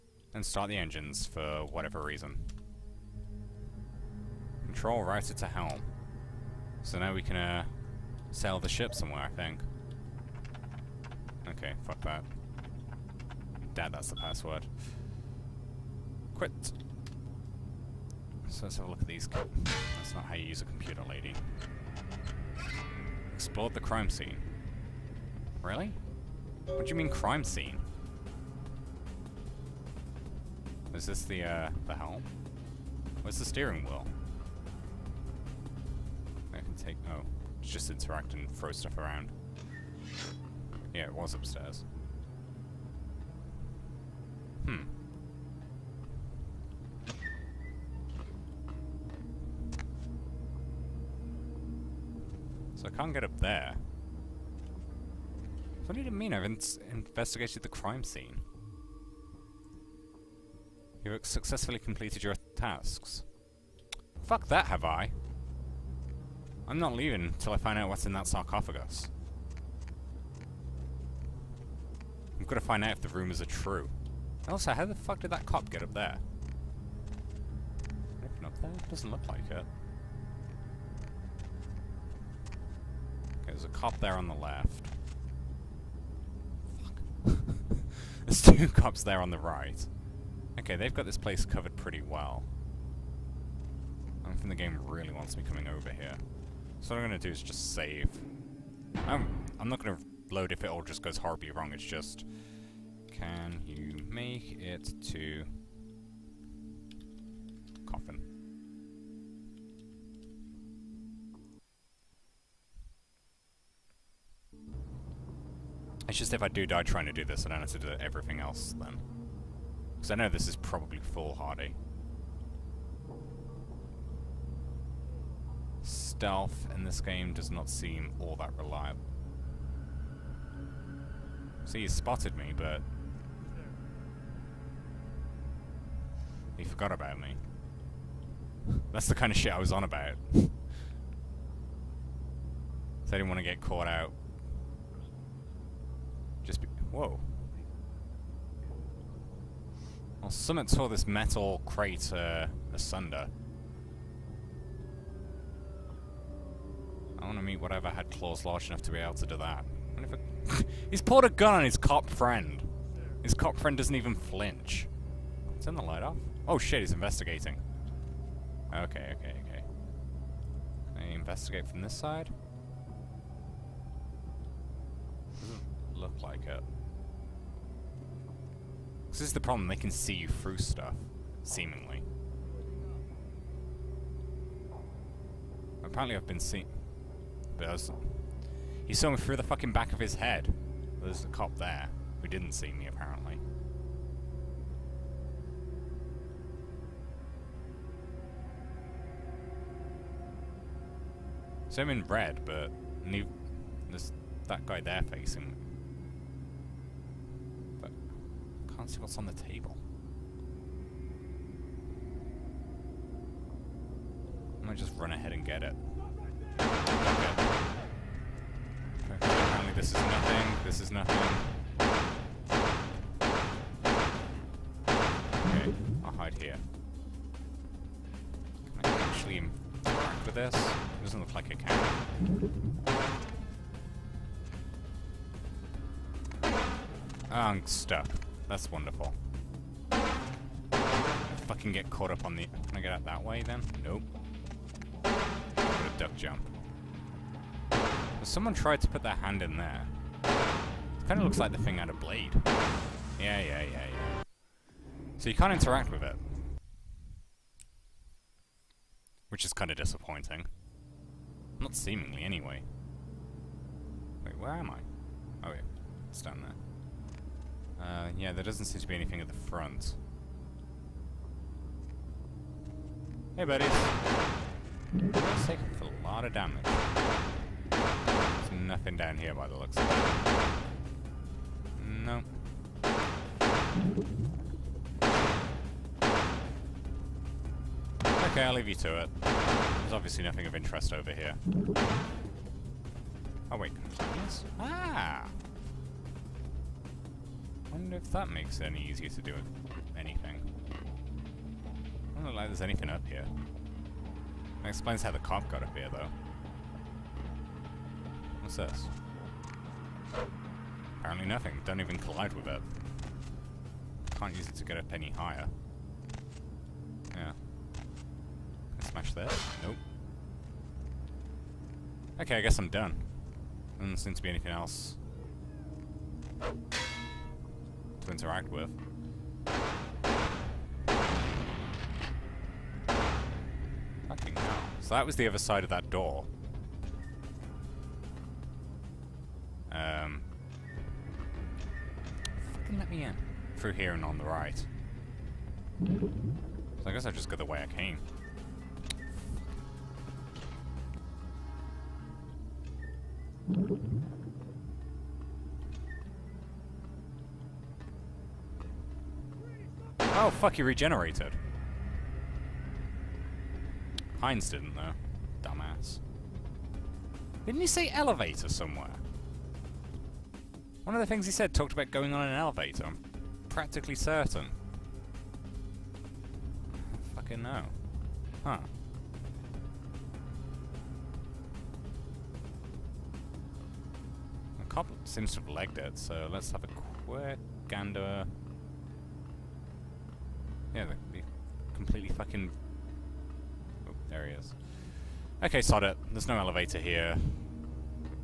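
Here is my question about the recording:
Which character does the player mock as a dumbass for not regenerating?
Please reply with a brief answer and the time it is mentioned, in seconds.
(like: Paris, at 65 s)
Heinz, at 364 s.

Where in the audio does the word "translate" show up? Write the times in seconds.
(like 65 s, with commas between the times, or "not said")
not said.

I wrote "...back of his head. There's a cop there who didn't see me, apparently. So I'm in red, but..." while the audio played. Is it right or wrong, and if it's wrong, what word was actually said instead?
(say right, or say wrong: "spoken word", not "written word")
right.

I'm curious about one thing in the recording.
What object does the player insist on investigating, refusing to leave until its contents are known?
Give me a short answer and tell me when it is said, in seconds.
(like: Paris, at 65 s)
Sarcophagus, at 68 s.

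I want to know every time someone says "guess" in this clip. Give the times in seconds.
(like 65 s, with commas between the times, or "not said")
322 s, 346 s.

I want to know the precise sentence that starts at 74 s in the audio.
Also, how the fuck did that cop get up there?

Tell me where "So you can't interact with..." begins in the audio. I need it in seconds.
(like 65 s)
255 s.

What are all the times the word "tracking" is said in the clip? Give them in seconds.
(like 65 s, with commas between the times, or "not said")
not said.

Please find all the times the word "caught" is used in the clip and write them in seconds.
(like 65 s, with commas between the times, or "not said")
143 s, 241 s.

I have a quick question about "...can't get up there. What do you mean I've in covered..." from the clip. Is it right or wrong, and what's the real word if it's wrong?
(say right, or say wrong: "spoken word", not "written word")
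wrong: "investigated", not "covered".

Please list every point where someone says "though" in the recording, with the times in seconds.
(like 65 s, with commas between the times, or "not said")
305 s, 364 s.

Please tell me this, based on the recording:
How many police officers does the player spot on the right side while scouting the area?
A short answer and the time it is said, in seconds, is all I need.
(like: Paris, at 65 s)
2, at 88 s.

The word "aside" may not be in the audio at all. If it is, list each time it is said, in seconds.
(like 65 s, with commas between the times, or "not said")
not said.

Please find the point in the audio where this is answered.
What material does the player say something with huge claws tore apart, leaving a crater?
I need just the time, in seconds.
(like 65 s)
151 s.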